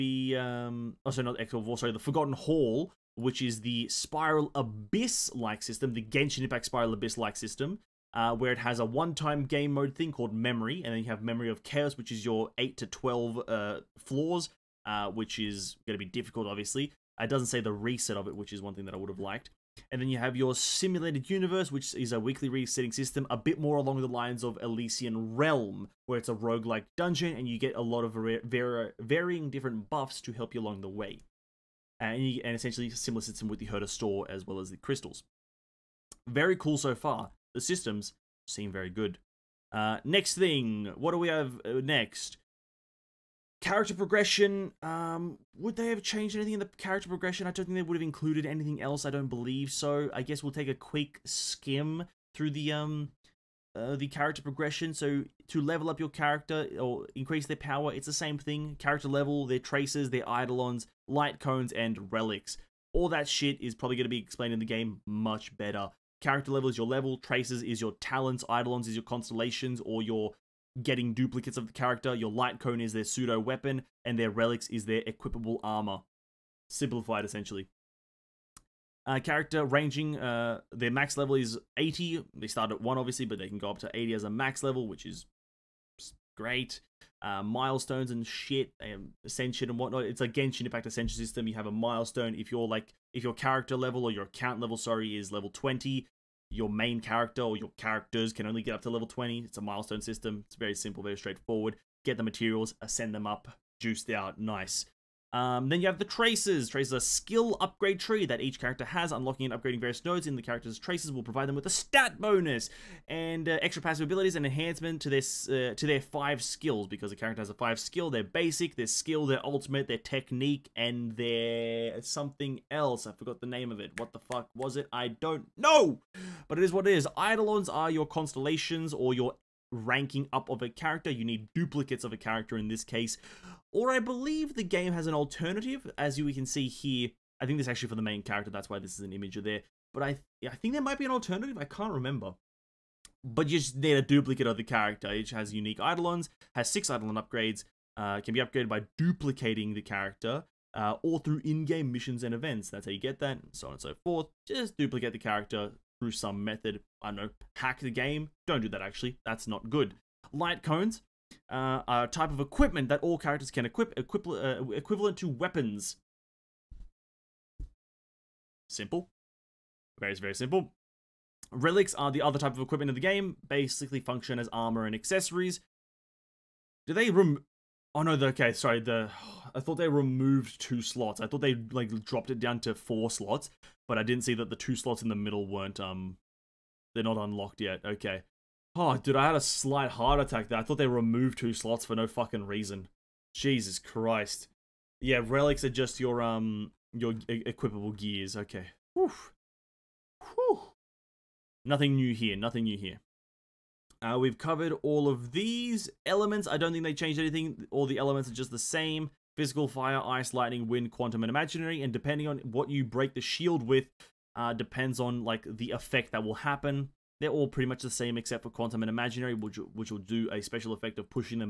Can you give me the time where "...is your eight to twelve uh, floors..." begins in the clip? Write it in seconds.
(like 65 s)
12 s.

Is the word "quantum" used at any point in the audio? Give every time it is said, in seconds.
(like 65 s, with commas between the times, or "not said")
210 s, 218 s.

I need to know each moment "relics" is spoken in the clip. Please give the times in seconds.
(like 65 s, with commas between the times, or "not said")
62 s, 74 s, 171 s, 195 s.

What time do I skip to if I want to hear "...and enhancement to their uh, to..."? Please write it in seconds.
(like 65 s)
114 s.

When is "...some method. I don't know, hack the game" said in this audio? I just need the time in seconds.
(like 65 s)
156 s.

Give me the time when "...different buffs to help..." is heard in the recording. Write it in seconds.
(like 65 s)
29 s.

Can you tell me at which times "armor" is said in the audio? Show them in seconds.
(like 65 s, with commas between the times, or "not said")
75 s, 174 s.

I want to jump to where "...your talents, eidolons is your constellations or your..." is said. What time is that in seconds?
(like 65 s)
67 s.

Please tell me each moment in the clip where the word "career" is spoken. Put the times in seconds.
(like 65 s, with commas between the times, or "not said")
not said.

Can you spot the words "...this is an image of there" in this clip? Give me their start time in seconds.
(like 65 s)
138 s.